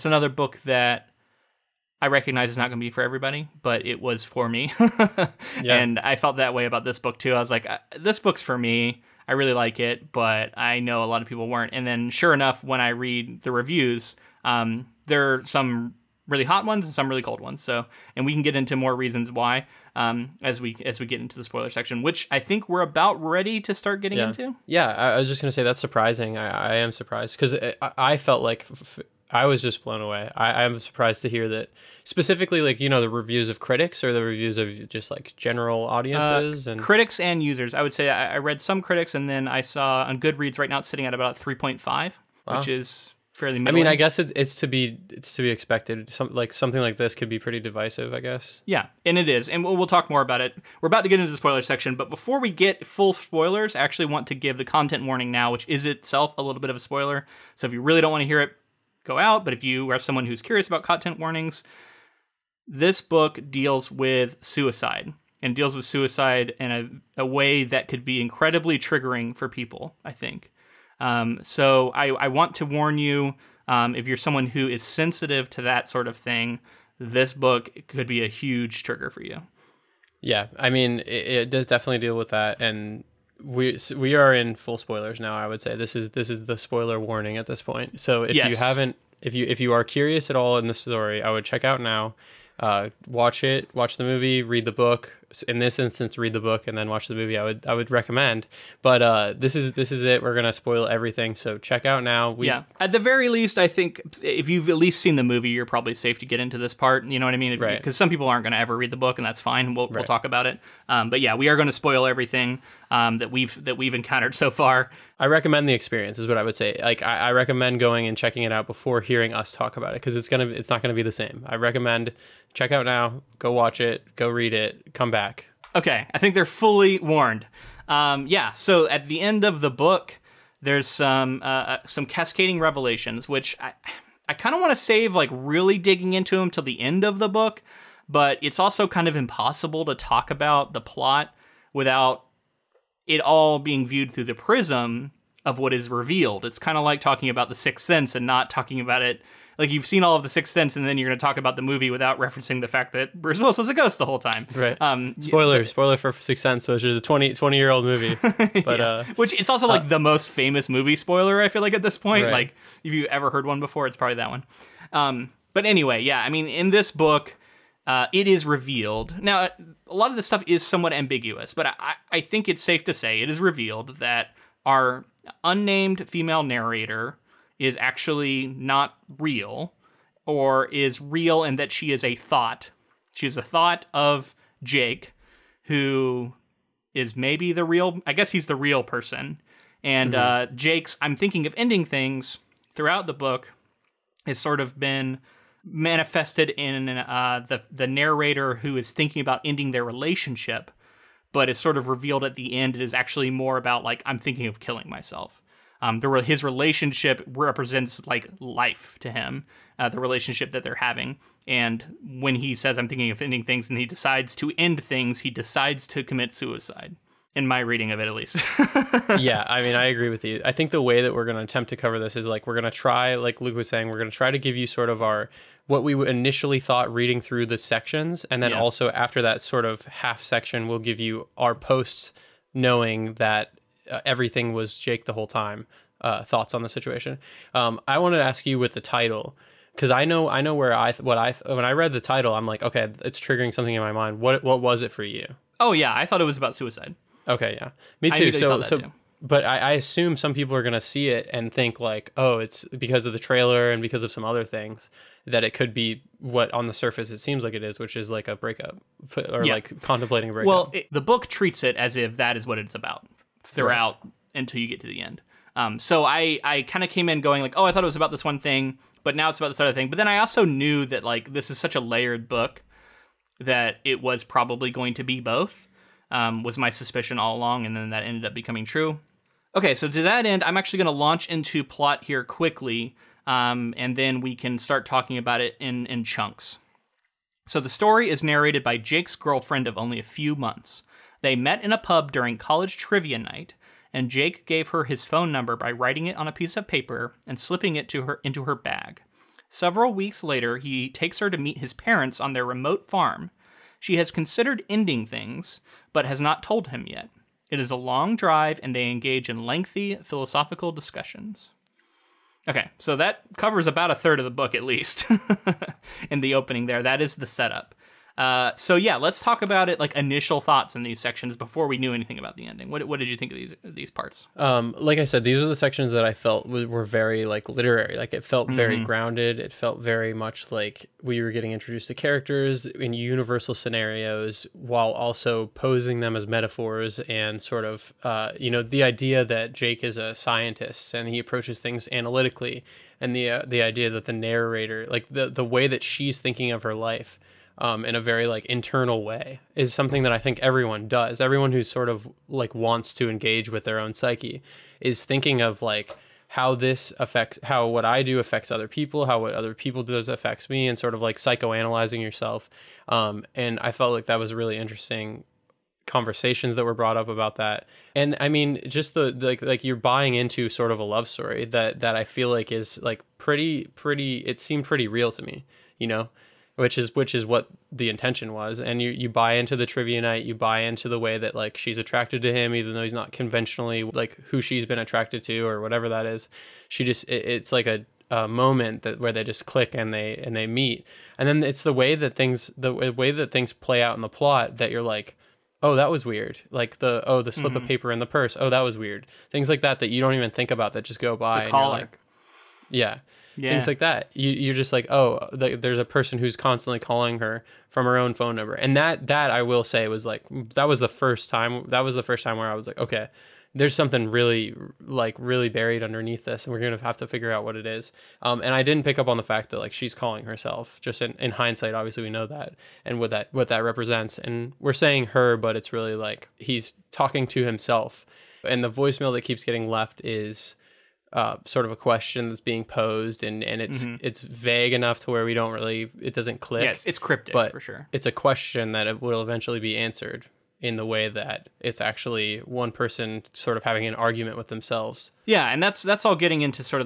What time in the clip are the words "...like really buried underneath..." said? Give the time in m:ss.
6:54.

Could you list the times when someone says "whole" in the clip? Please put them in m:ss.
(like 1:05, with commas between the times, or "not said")
2:34, 3:55.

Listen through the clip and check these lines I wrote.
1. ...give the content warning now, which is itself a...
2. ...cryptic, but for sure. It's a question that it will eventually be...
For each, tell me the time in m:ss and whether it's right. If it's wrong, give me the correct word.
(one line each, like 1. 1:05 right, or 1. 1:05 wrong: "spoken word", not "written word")
1. 0:54 right
2. 7:16 right.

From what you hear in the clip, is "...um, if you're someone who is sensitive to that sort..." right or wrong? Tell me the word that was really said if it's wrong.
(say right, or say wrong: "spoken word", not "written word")
right.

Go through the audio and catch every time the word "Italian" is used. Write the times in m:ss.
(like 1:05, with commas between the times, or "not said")
not said.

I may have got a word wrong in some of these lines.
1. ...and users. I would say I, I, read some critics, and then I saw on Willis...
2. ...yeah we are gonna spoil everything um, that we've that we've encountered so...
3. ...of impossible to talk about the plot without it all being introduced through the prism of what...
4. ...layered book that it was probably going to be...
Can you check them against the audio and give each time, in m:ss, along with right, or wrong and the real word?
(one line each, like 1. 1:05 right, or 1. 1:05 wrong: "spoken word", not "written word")
1. 0:37 wrong: "Goodreads", not "Willis"
2. 1:51 right
3. 2:19 wrong: "viewed", not "introduced"
4. 4:31 right.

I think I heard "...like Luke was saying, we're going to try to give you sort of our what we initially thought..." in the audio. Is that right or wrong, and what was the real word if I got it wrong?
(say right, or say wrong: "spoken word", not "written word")
right.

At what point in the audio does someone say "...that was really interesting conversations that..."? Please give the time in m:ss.
6:04.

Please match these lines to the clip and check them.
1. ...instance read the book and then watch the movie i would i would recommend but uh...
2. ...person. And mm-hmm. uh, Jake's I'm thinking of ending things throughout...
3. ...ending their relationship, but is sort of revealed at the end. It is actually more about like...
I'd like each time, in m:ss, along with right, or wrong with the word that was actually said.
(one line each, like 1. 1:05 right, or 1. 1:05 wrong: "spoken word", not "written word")
1. 1:35 right
2. 3:08 right
3. 3:19 right.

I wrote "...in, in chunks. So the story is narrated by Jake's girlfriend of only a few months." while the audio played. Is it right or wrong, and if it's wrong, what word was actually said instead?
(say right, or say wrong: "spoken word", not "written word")
right.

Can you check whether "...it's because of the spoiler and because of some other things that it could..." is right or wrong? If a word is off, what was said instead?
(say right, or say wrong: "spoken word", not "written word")
wrong: "trailer", not "spoiler".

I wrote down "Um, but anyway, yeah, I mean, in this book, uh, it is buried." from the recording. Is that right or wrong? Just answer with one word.
wrong.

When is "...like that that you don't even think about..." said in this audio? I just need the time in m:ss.
6:39.